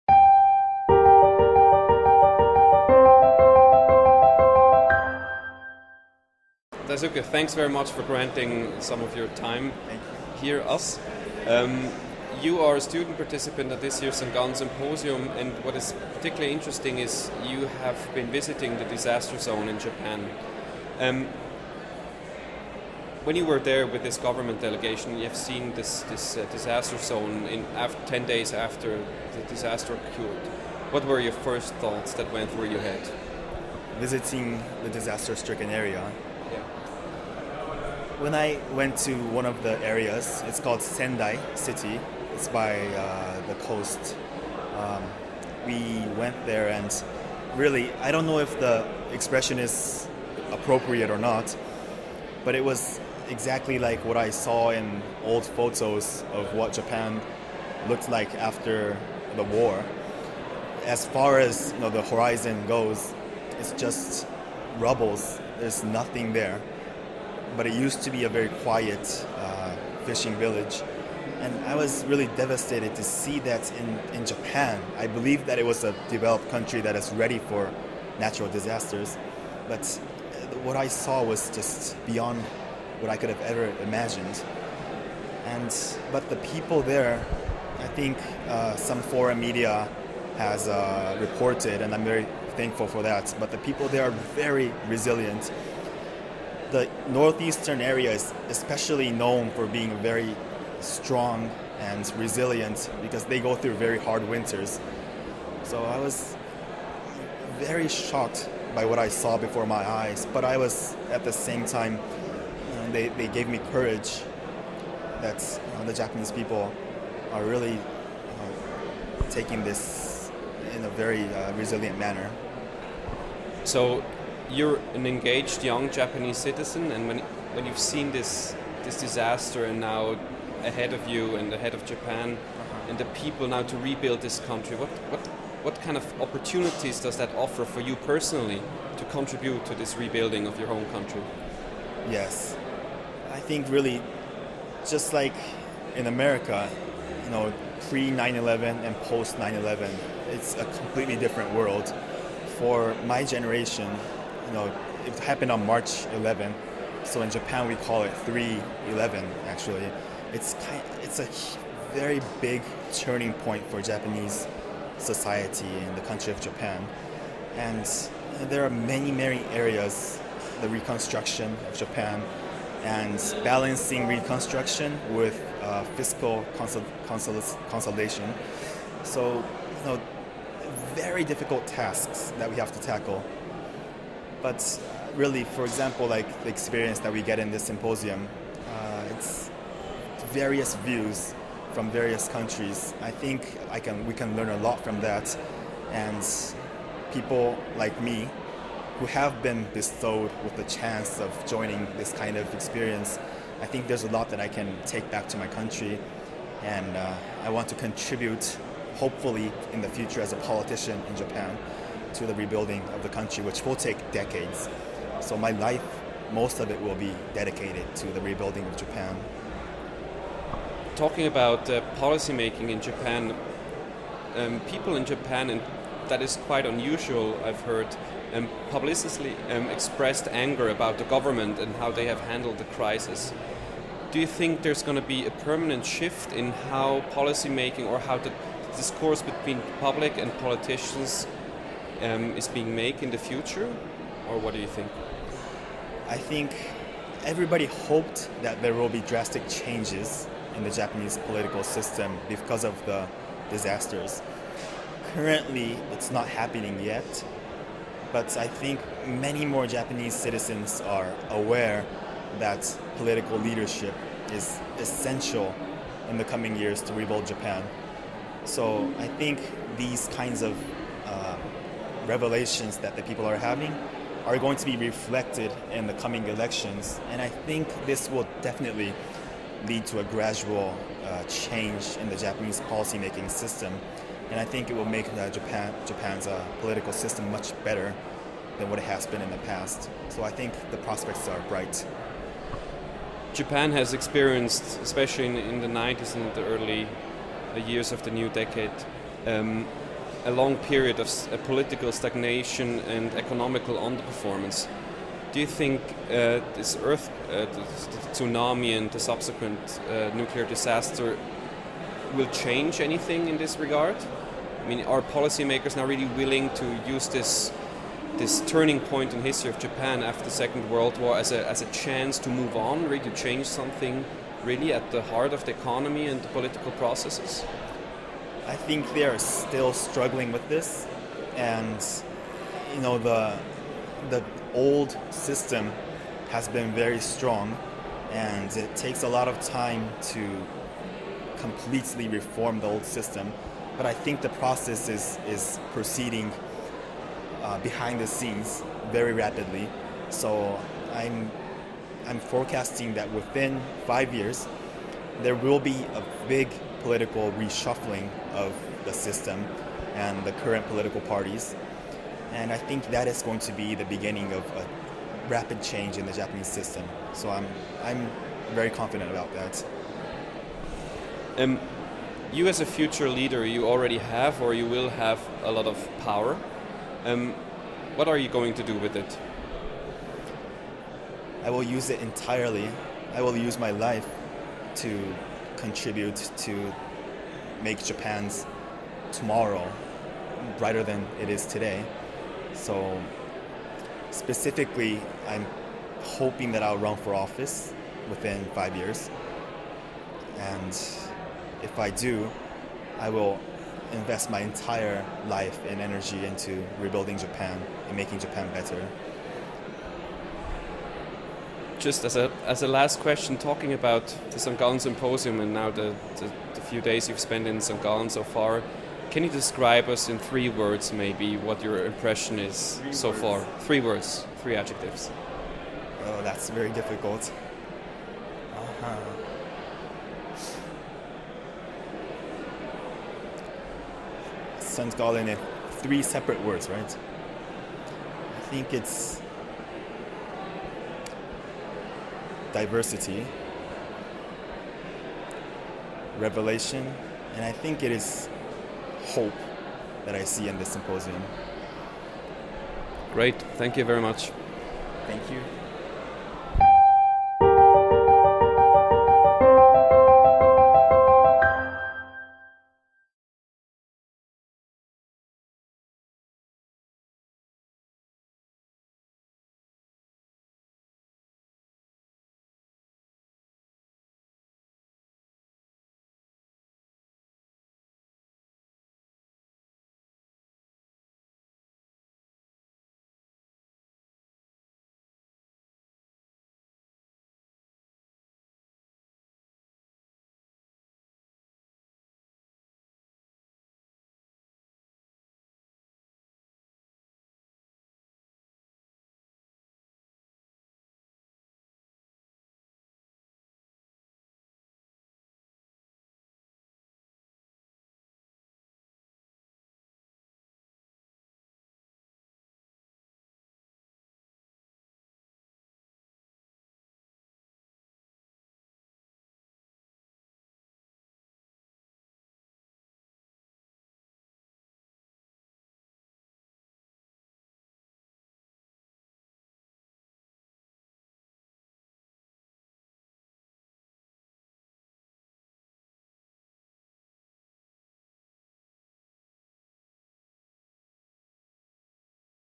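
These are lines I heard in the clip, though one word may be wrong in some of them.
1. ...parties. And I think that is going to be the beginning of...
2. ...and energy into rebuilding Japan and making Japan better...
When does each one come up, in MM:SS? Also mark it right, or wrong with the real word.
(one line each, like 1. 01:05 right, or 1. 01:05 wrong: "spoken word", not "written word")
1. 06:01 right
2. 06:45 right.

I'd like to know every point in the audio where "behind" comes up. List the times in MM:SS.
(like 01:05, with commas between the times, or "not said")
05:47.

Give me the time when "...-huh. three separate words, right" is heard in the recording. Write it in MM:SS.
07:14.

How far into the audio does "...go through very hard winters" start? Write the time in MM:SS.
01:43.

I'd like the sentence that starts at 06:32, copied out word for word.
So specifically, I'm hoping that I'll run for office within five years.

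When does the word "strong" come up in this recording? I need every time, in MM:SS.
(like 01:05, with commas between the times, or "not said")
01:40, 05:36.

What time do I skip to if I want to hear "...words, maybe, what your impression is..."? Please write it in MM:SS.
07:00.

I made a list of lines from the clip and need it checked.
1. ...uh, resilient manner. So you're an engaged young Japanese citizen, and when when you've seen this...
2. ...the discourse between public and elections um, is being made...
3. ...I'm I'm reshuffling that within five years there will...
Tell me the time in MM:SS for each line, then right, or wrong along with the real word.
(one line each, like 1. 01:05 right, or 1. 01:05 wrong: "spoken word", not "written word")
1. 02:01 right
2. 03:58 wrong: "politicians", not "elections"
3. 05:50 wrong: "forecasting", not "reshuffling".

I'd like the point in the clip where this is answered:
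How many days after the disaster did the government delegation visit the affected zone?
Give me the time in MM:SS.
00:28.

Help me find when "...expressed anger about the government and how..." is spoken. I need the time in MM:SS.
03:49.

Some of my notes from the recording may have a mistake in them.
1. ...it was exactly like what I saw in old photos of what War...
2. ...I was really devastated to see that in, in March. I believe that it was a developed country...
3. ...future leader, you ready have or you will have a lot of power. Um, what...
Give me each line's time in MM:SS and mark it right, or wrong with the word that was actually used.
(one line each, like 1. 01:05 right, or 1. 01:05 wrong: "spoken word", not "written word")
1. 00:52 wrong: "Japan", not "War"
2. 01:11 wrong: "Japan", not "March"
3. 06:12 wrong: "already", not "ready".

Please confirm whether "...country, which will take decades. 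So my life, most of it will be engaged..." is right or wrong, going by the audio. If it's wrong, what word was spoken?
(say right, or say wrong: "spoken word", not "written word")
wrong: "dedicated", not "engaged".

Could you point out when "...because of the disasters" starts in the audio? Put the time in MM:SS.
04:12.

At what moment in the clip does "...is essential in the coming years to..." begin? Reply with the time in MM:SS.
04:24.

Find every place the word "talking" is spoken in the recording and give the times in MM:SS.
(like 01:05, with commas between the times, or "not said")
03:40, 06:53.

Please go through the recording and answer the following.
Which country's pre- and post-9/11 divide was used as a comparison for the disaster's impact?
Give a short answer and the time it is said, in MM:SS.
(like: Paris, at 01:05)
America, at 02:26.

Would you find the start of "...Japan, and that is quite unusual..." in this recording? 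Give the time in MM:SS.
03:45.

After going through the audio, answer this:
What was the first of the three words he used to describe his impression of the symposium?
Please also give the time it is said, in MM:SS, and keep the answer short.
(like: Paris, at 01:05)
Diversity, at 07:22.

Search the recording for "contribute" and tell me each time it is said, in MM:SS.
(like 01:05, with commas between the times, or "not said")
02:19, 03:27, 06:25.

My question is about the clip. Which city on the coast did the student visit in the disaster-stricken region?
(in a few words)
Sendai.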